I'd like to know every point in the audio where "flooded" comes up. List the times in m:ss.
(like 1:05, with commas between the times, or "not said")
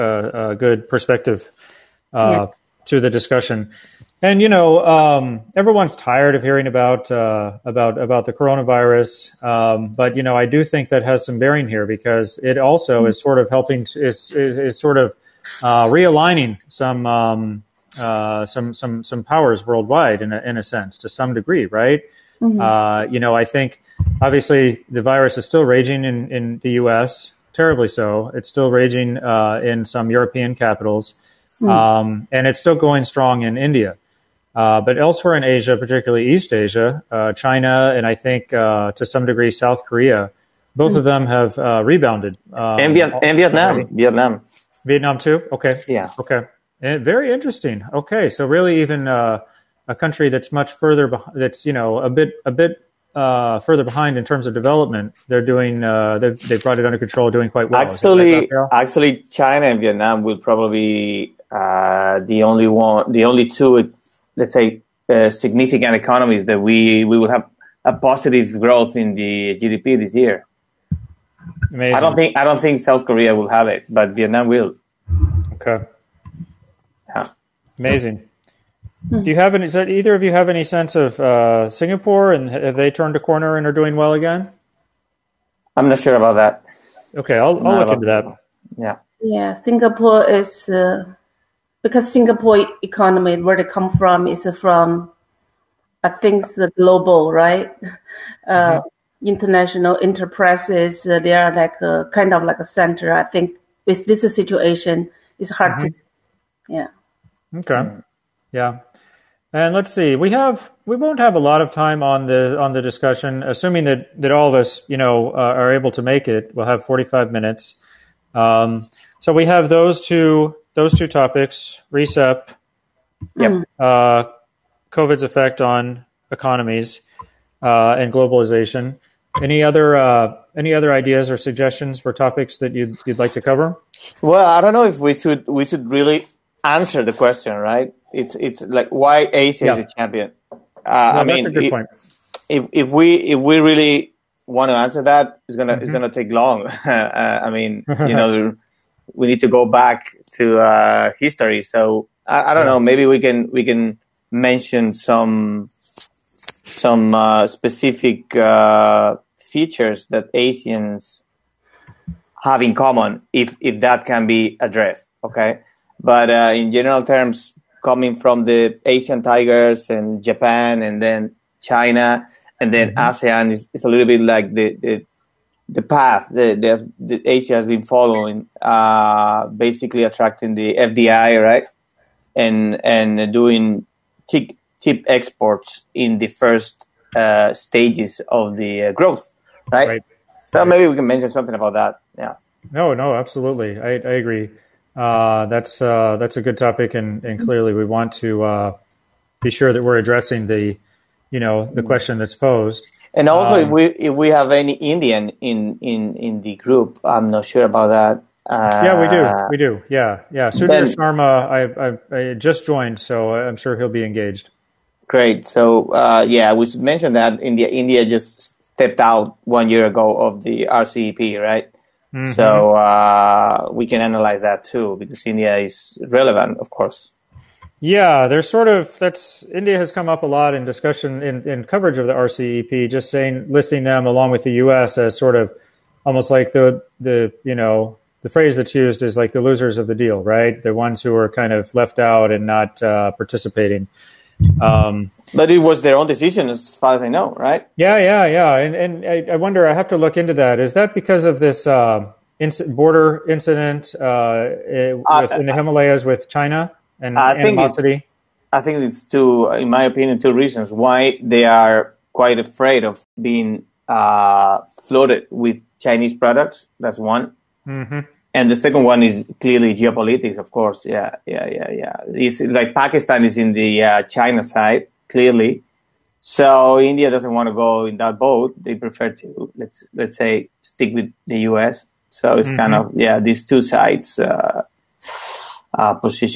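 4:24.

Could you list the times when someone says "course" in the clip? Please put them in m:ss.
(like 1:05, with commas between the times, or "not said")
3:46, 4:30.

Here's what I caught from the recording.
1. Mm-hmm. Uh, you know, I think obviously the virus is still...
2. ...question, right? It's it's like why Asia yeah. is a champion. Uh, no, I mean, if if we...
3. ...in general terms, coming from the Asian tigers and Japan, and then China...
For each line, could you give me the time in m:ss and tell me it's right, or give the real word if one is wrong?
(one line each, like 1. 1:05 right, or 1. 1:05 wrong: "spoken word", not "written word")
1. 0:22 right
2. 2:17 right
3. 2:46 right.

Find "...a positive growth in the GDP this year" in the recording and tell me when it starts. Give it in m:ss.
1:07.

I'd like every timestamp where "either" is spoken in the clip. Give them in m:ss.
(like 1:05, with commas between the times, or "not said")
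1:19.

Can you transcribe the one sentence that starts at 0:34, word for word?
Uh, but elsewhere in Asia, particularly East Asia, uh, China, and I think uh, to some degree South Korea, both of hmm.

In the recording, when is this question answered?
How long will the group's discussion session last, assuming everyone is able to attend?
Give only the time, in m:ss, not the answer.
1:56.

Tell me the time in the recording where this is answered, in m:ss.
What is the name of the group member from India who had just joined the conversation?
3:30.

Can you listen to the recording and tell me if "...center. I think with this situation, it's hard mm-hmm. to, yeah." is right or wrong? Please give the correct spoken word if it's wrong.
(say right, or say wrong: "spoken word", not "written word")
right.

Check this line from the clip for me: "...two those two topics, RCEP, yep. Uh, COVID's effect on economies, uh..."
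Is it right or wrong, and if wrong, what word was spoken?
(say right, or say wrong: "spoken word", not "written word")
right.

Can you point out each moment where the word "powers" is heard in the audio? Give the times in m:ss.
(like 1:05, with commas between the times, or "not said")
0:19.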